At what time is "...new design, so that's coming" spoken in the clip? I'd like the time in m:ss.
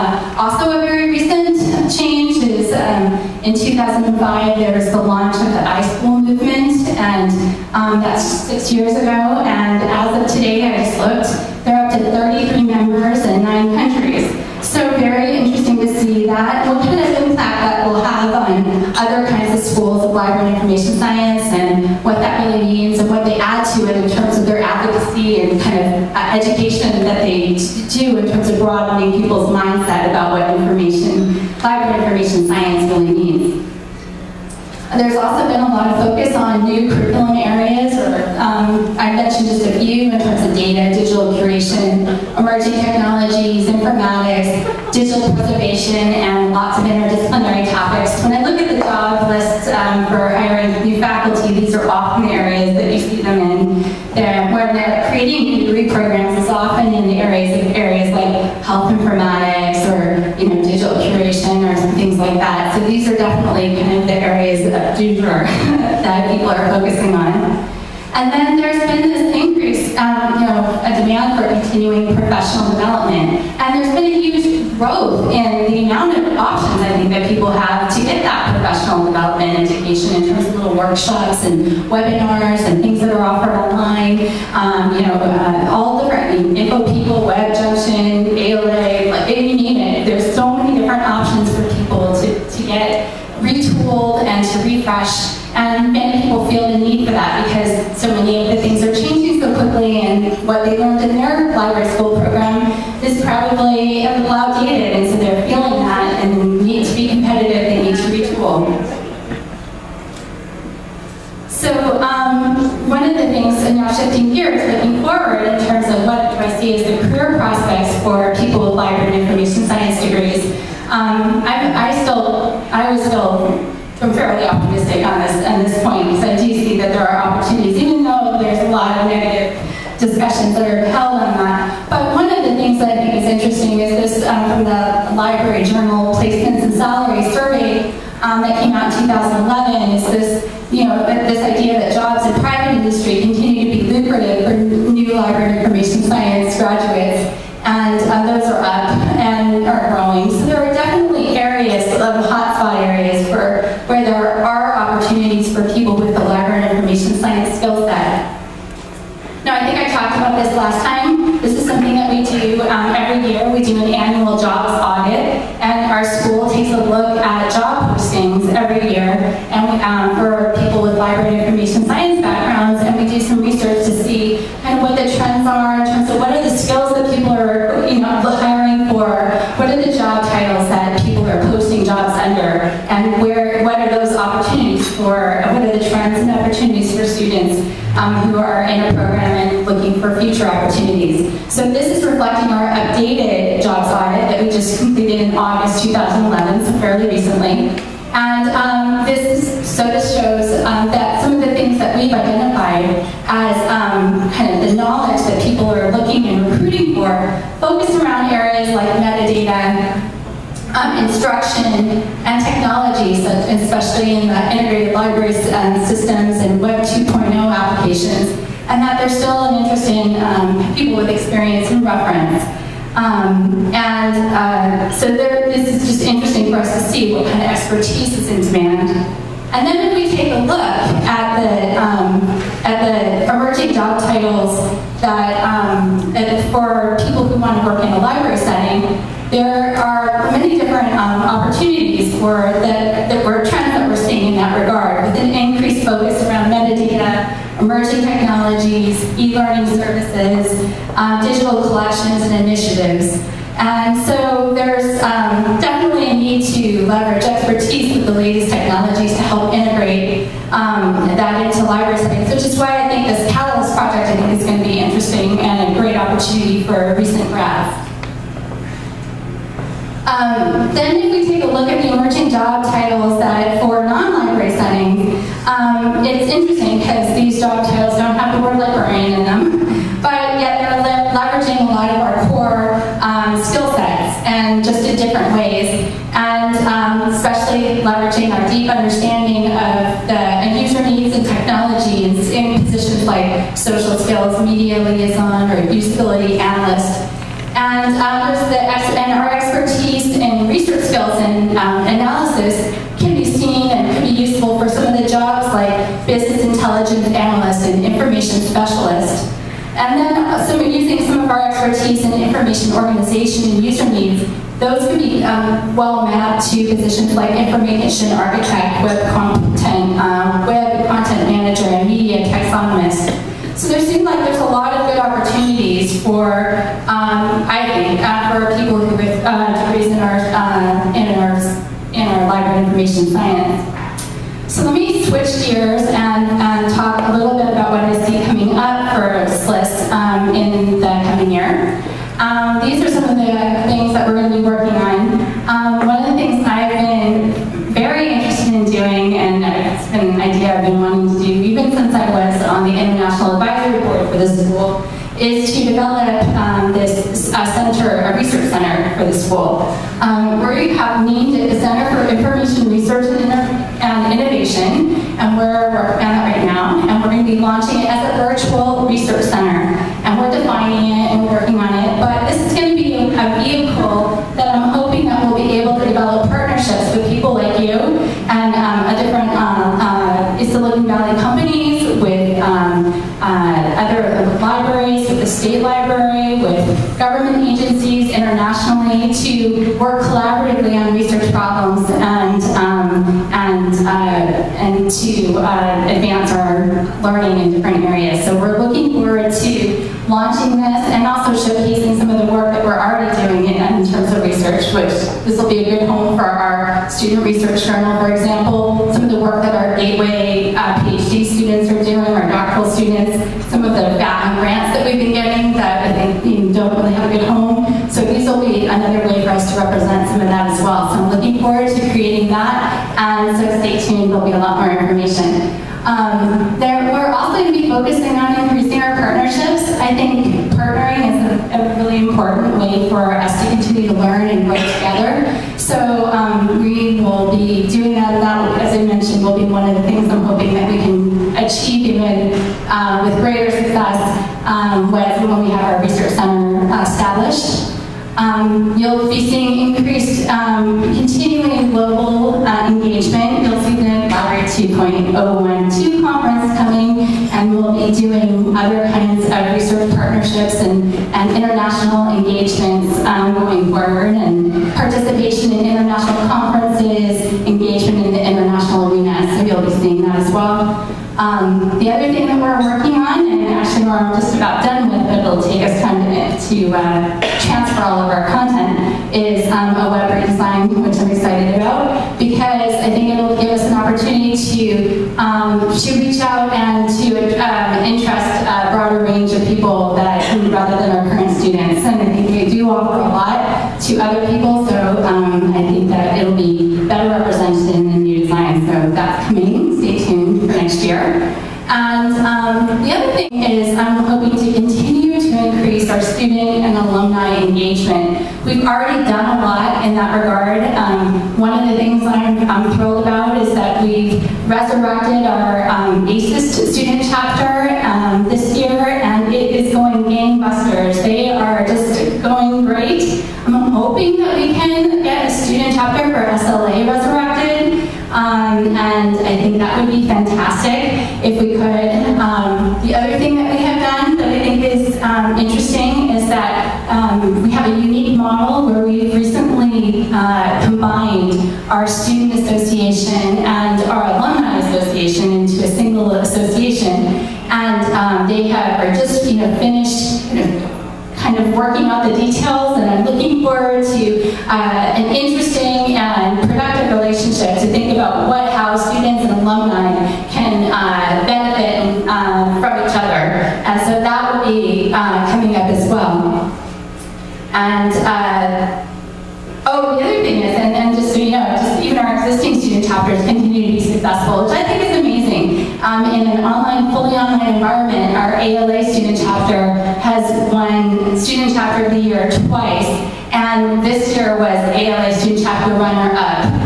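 8:17.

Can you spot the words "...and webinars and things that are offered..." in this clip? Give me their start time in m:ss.
1:21.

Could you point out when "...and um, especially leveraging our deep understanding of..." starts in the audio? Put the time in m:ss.
4:46.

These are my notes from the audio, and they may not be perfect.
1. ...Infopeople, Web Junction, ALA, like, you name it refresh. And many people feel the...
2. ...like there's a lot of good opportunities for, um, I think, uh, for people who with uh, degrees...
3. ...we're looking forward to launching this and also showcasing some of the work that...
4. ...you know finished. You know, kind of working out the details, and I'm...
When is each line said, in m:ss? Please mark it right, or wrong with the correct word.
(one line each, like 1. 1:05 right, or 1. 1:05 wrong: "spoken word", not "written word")
1. 1:26 right
2. 5:24 right
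3. 6:38 right
4. 9:09 right.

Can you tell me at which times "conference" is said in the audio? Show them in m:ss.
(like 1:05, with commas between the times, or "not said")
7:36, 7:46.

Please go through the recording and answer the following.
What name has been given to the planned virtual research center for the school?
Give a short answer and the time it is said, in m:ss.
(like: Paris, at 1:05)
Center for Information Research, at 6:01.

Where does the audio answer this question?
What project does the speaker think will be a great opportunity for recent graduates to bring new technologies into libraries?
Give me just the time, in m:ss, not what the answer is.
4:23.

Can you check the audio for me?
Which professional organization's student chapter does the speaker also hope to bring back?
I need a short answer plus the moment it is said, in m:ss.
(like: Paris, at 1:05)
SLA, at 8:46.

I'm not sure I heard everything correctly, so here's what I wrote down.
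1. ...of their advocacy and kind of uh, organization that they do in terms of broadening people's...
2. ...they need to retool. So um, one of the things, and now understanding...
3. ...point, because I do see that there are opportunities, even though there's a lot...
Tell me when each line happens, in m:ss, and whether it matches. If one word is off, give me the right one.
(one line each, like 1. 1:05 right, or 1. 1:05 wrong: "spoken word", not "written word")
1. 0:24 wrong: "education", not "organization"
2. 1:47 wrong: "shifting", not "understanding"
3. 2:05 right.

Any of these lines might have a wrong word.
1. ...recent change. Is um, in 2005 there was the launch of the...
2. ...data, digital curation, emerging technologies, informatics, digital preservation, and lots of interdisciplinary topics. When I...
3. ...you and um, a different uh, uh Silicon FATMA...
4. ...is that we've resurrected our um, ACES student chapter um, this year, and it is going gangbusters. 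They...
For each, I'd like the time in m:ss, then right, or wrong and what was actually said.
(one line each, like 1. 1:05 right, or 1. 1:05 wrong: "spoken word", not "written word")
1. 0:01 right
2. 0:40 right
3. 6:17 wrong: "Valley", not "FATMA"
4. 8:33 right.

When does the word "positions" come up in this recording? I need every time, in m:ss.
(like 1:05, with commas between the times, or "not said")
4:52, 5:16.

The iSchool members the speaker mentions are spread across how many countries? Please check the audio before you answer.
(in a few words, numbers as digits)
9.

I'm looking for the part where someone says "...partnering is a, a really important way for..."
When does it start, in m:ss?
7:10.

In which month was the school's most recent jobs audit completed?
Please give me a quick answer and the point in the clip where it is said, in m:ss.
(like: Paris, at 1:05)
August 2011, at 3:15.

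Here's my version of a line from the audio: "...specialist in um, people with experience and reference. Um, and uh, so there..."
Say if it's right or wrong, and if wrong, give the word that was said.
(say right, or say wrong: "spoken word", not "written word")
wrong: "interest", not "specialist".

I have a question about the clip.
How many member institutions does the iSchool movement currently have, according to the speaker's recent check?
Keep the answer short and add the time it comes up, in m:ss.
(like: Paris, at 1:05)
33, at 0:12.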